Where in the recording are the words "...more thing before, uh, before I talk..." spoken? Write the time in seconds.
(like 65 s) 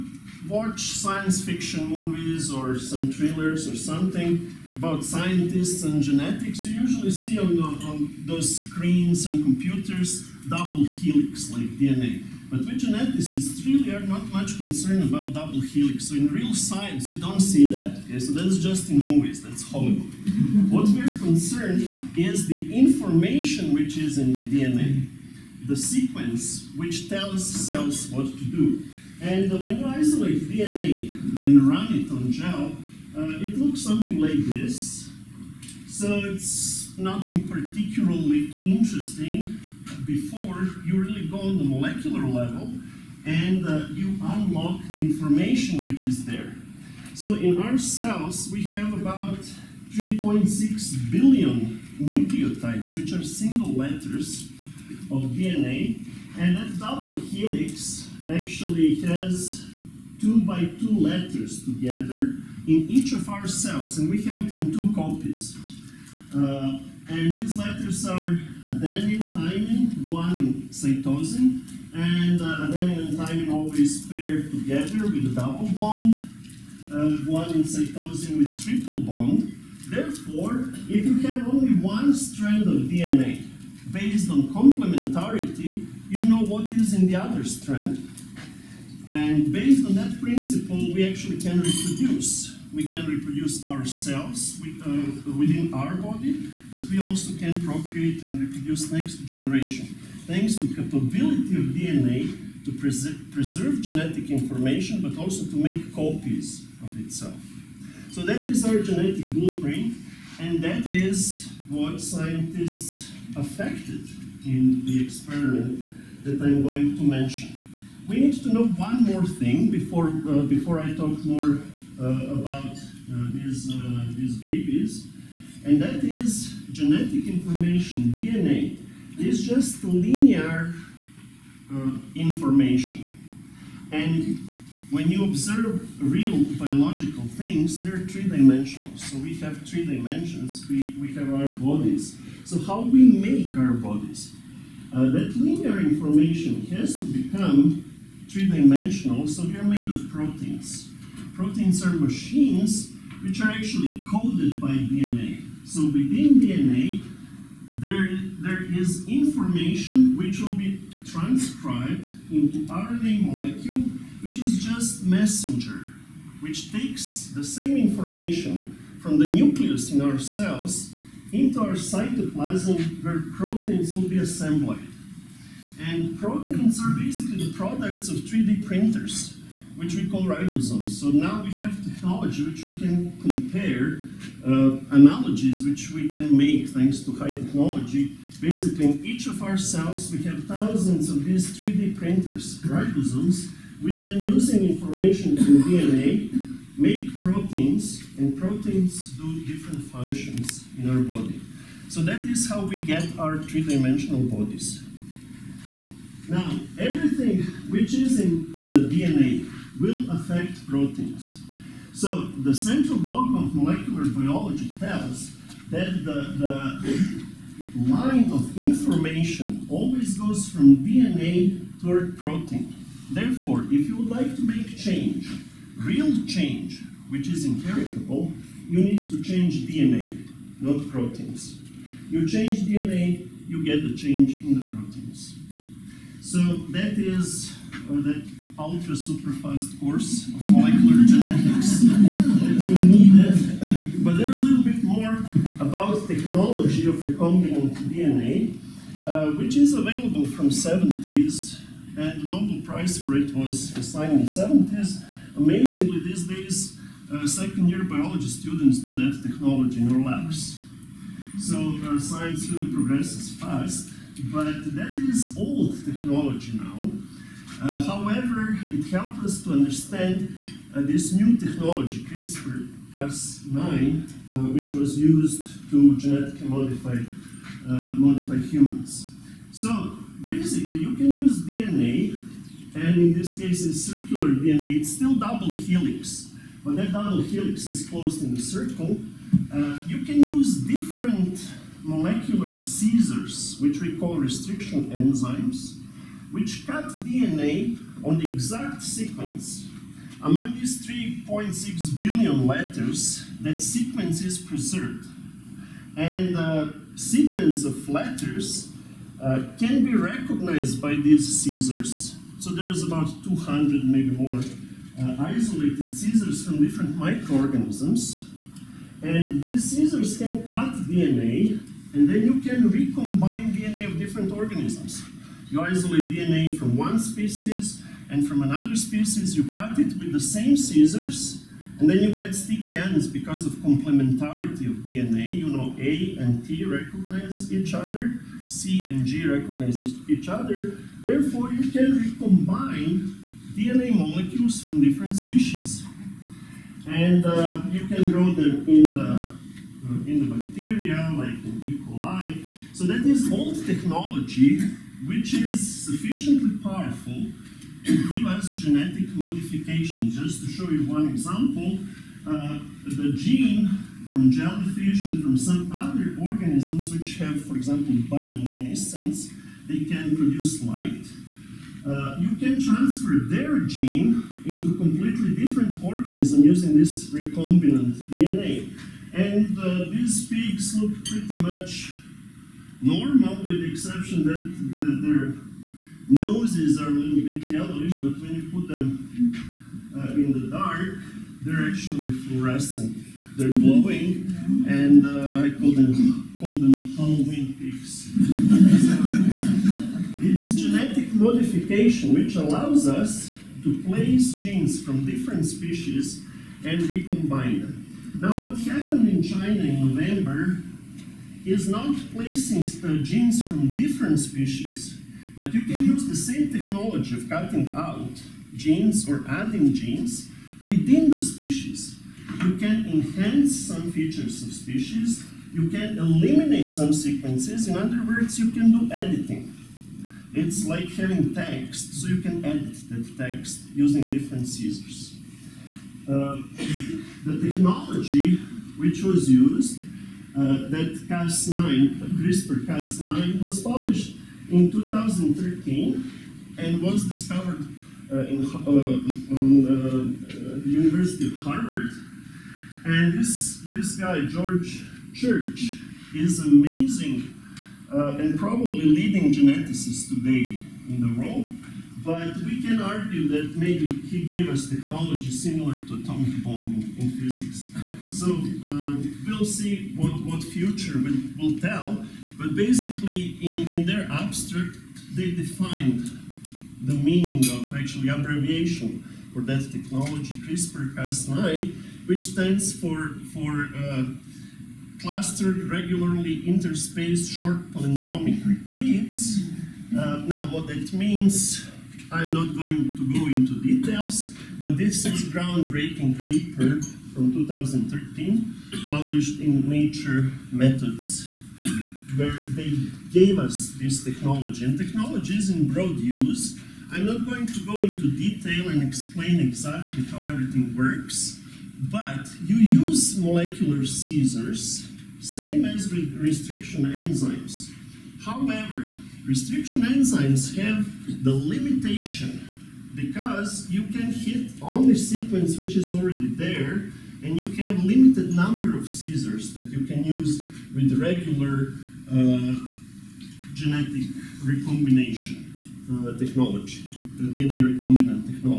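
119 s.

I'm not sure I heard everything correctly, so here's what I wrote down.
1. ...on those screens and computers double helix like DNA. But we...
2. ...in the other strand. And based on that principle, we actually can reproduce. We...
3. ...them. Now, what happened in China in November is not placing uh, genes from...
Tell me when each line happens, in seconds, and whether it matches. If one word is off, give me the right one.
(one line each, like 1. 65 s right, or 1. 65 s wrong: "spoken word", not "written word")
1. 7 s right
2. 86 s right
3. 407 s right.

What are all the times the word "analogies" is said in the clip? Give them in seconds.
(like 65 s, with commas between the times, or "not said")
184 s.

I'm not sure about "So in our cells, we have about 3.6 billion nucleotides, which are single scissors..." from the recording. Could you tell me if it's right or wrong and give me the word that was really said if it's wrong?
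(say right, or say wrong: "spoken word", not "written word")
wrong: "letters", not "scissors".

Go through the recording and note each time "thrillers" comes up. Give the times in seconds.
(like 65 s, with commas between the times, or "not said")
3 s.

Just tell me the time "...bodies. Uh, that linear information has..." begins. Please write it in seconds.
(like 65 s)
143 s.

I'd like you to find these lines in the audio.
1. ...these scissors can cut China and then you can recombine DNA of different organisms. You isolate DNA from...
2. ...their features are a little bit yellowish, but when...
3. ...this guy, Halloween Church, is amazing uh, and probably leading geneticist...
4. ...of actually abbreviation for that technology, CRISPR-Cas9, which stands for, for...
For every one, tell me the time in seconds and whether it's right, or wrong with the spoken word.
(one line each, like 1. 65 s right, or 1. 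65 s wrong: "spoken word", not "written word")
1. 319 s wrong: "DNA", not "China"
2. 385 s wrong: "noses", not "features"
3. 453 s wrong: "George", not "Halloween"
4. 477 s right.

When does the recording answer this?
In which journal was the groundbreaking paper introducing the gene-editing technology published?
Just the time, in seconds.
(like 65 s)
499 s.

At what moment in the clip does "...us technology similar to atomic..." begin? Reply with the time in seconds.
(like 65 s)
464 s.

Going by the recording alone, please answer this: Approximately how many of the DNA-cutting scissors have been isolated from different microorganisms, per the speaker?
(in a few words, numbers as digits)
about 200.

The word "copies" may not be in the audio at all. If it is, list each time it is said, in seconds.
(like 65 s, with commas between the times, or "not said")
64 s, 105 s.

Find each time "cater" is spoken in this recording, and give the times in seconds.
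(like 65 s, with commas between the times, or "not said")
not said.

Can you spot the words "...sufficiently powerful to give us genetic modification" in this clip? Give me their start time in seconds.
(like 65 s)
355 s.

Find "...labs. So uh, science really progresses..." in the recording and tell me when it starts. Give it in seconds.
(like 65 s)
260 s.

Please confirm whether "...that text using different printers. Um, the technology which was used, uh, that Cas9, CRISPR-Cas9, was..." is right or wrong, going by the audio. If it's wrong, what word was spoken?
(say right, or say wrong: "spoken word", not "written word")
wrong: "scissors", not "printers".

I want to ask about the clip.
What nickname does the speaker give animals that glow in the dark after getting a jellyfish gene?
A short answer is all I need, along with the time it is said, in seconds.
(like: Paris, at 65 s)
Halloween peaks, at 396 s.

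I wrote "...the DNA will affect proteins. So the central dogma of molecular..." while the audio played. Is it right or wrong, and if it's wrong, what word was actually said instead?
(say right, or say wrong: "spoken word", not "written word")
right.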